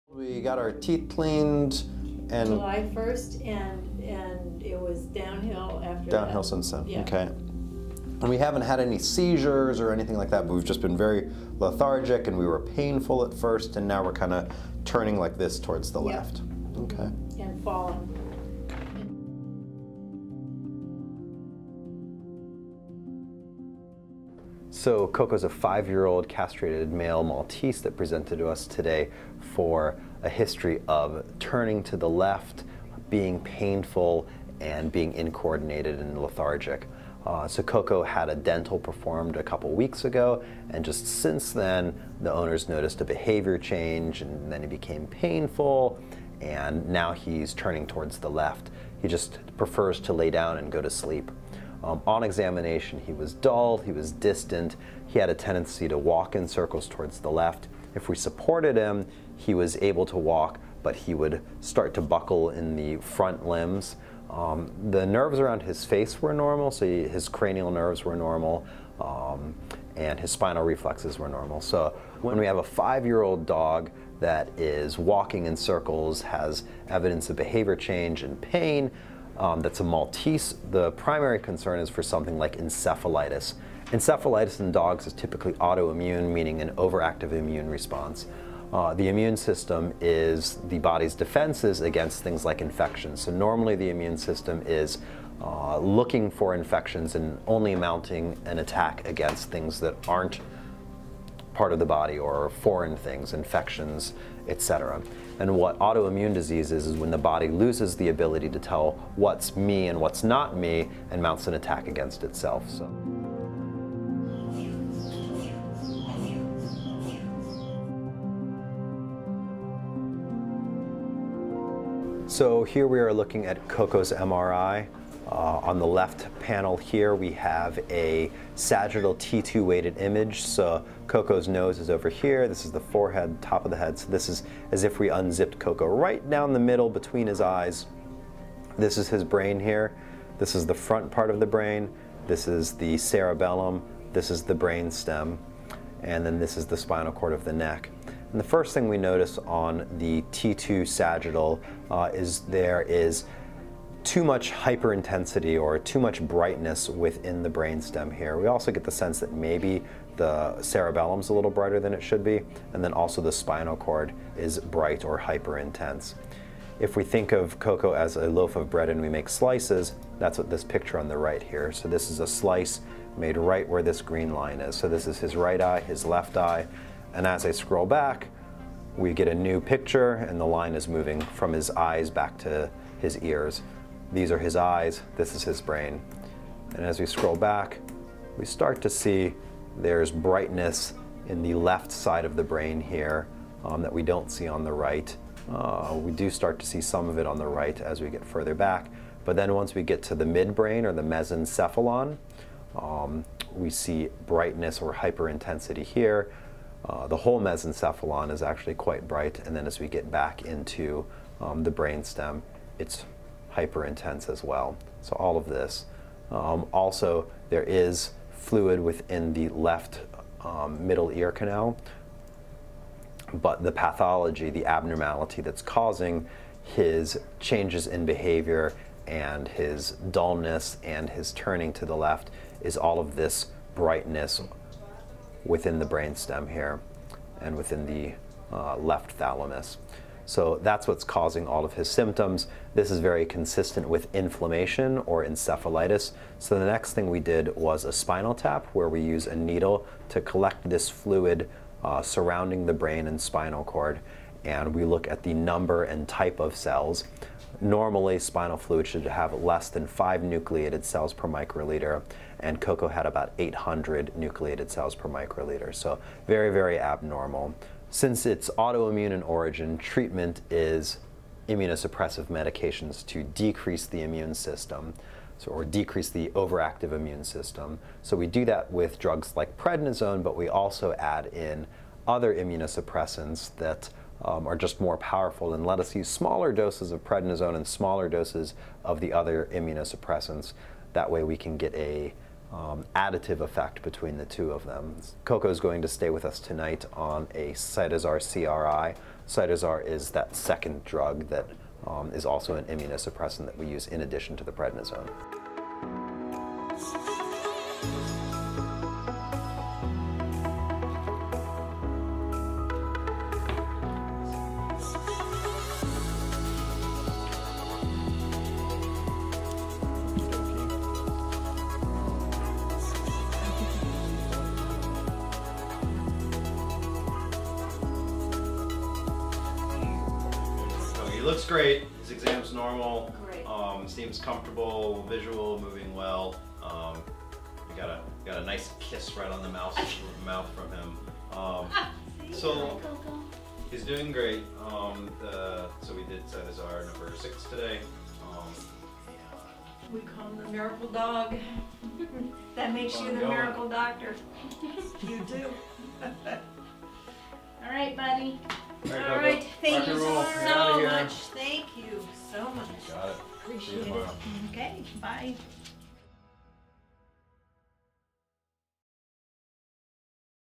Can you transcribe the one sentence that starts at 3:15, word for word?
Uh, we do start to see some of it on the right as we get further back.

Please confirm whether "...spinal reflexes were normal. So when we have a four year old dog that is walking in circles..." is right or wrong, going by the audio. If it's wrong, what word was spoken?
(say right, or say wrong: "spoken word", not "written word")
wrong: "five", not "four".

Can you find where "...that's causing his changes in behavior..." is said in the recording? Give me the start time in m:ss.
3:45.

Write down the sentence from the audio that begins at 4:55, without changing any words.
Coco is going to stay with us tonight on a Cytosar CRI.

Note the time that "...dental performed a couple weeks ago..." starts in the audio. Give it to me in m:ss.
0:38.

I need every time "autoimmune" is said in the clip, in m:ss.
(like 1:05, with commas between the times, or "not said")
1:25, 1:45, 4:28.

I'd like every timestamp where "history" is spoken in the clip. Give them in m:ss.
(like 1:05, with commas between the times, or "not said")
0:30.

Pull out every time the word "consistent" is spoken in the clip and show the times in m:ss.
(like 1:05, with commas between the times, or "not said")
4:03.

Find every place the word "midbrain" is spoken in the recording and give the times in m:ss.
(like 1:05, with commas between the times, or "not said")
3:20.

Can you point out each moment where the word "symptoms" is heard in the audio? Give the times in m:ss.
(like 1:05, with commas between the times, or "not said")
4:01.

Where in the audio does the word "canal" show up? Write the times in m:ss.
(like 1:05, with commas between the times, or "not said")
3:41.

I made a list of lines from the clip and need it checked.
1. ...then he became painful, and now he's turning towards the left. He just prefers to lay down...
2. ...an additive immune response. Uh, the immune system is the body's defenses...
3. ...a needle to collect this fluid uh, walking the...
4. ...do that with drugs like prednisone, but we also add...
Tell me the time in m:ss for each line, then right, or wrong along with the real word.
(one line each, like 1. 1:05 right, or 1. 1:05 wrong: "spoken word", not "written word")
1. 0:44 right
2. 1:26 wrong: "overactive", not "additive"
3. 4:09 wrong: "surrounding", not "walking"
4. 4:38 right.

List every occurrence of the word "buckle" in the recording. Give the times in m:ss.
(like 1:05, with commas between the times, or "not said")
1:02.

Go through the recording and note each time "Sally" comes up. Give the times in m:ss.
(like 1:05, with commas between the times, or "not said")
not said.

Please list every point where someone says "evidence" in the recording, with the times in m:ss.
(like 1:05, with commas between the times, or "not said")
1:16.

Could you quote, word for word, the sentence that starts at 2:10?
So Coco's nose is over here.